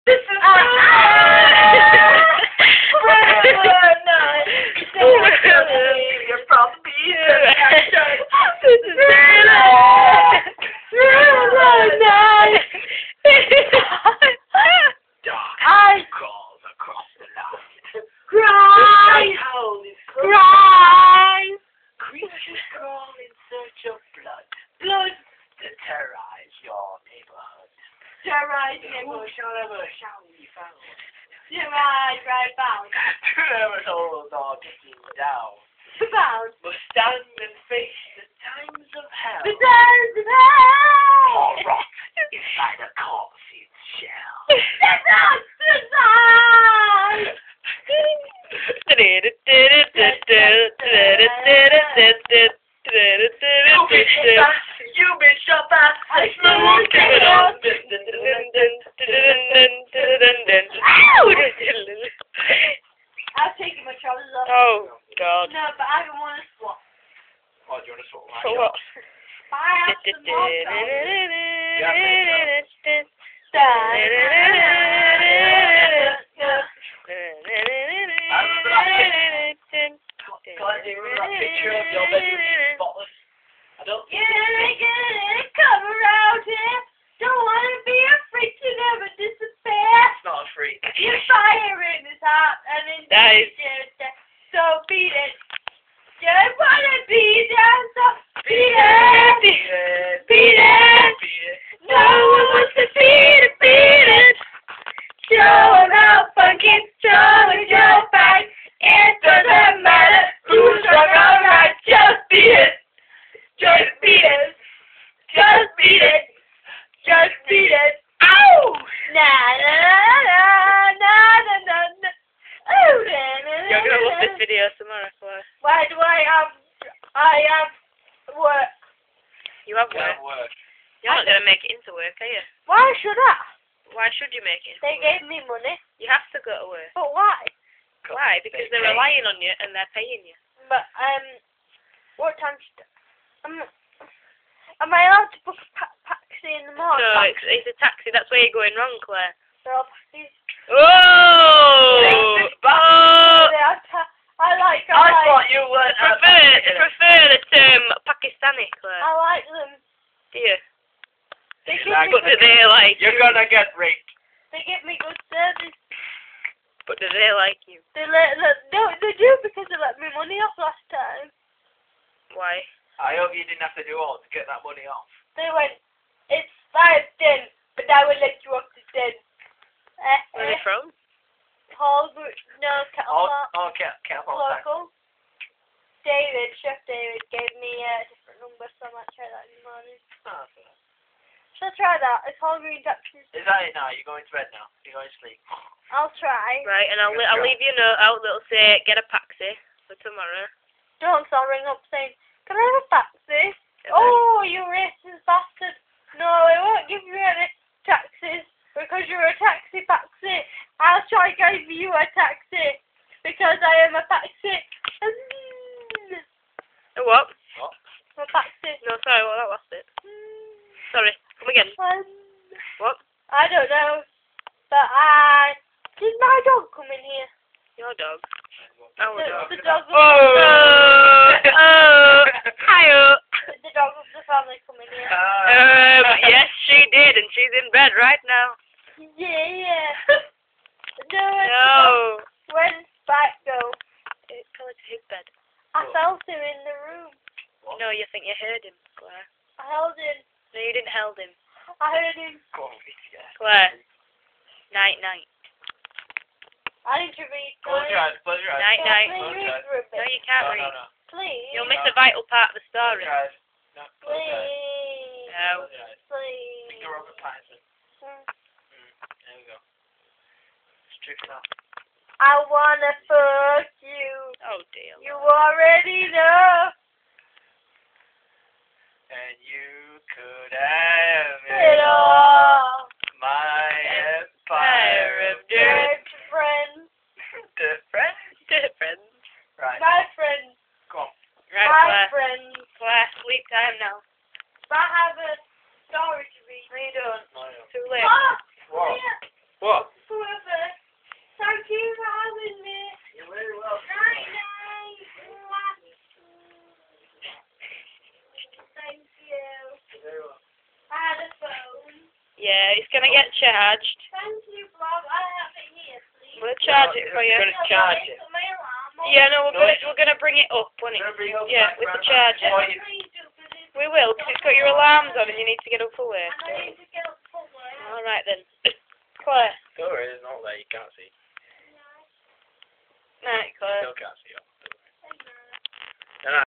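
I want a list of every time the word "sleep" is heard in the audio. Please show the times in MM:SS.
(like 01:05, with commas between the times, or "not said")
03:15.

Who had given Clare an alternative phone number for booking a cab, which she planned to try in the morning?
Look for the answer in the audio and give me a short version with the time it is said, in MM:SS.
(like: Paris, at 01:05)
Chef David, at 03:06.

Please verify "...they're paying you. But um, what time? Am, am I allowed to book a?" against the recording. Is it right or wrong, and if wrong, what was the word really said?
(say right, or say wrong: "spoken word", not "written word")
right.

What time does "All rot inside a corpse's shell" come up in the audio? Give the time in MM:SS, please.
00:41.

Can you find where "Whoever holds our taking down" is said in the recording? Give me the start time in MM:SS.
00:32.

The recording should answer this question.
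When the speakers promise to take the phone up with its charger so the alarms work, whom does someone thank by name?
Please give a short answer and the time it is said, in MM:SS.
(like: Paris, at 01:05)
Bob, at 05:14.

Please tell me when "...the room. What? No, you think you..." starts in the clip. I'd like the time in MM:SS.
04:06.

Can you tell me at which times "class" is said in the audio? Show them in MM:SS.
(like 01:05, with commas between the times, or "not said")
04:51.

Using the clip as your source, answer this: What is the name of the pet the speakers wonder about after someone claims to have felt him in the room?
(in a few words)
Spike.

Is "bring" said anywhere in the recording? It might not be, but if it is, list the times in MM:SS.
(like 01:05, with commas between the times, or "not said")
05:20.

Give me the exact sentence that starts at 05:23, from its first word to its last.
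We will, because it's got your alarms on and you need to get up for work.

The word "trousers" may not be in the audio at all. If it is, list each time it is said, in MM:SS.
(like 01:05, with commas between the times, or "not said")
01:04.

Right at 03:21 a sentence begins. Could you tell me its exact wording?
No, so I'll ring up saying, can I have a taxi?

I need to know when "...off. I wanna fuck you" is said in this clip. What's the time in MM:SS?
04:31.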